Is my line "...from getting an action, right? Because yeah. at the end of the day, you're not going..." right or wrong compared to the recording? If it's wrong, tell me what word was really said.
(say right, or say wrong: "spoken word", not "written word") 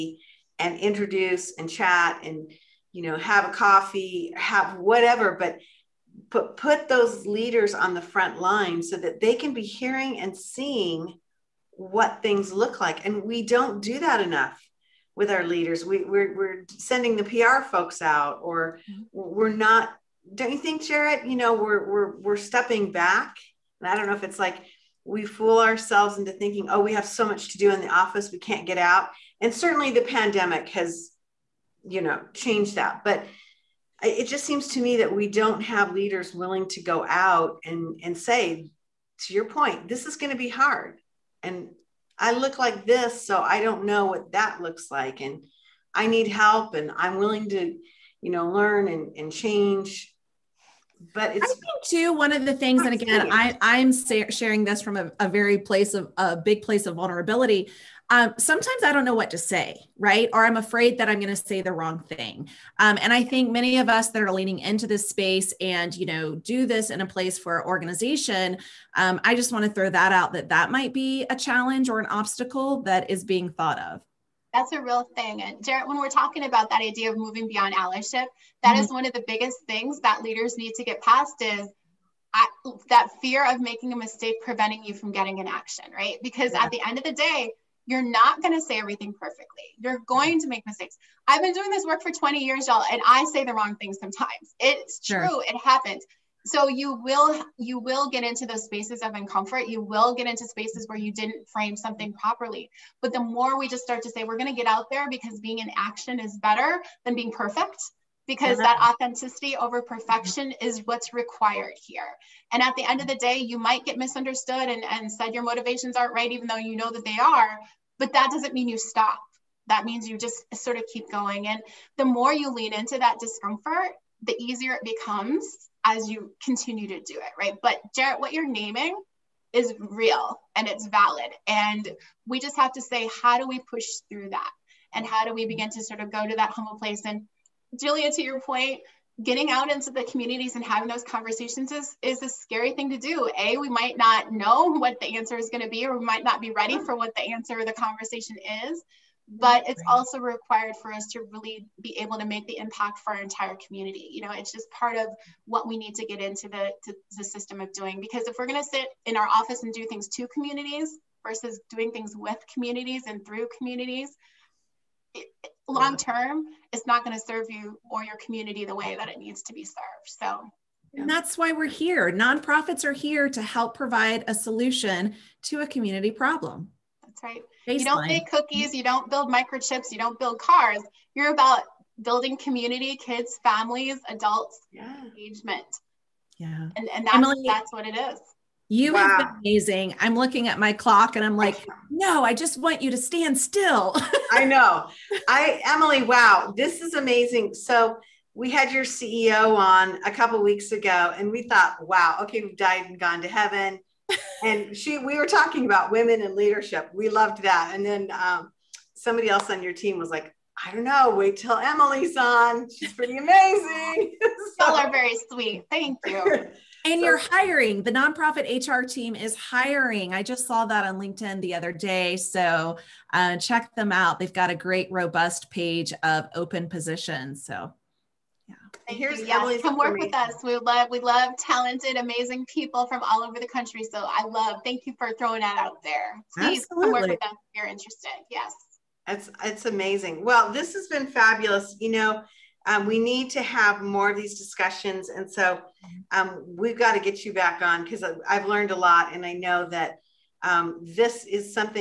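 right.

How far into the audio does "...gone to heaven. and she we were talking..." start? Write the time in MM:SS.
03:22.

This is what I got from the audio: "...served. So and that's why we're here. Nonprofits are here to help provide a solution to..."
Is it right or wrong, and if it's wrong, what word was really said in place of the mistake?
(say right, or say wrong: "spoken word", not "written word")
right.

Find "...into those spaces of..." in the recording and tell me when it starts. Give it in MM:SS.
01:38.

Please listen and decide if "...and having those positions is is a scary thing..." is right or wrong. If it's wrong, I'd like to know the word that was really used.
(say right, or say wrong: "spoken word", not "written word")
wrong: "conversations", not "positions".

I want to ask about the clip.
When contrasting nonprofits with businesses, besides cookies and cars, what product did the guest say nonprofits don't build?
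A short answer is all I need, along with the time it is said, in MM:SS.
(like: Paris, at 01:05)
microchips, at 02:59.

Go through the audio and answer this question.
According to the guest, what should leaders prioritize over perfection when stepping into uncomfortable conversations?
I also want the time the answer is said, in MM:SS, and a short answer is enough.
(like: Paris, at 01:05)
authenticity, at 01:48.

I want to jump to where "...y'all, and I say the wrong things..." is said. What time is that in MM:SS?
01:32.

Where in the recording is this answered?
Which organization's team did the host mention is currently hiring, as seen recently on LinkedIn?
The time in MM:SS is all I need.
03:37.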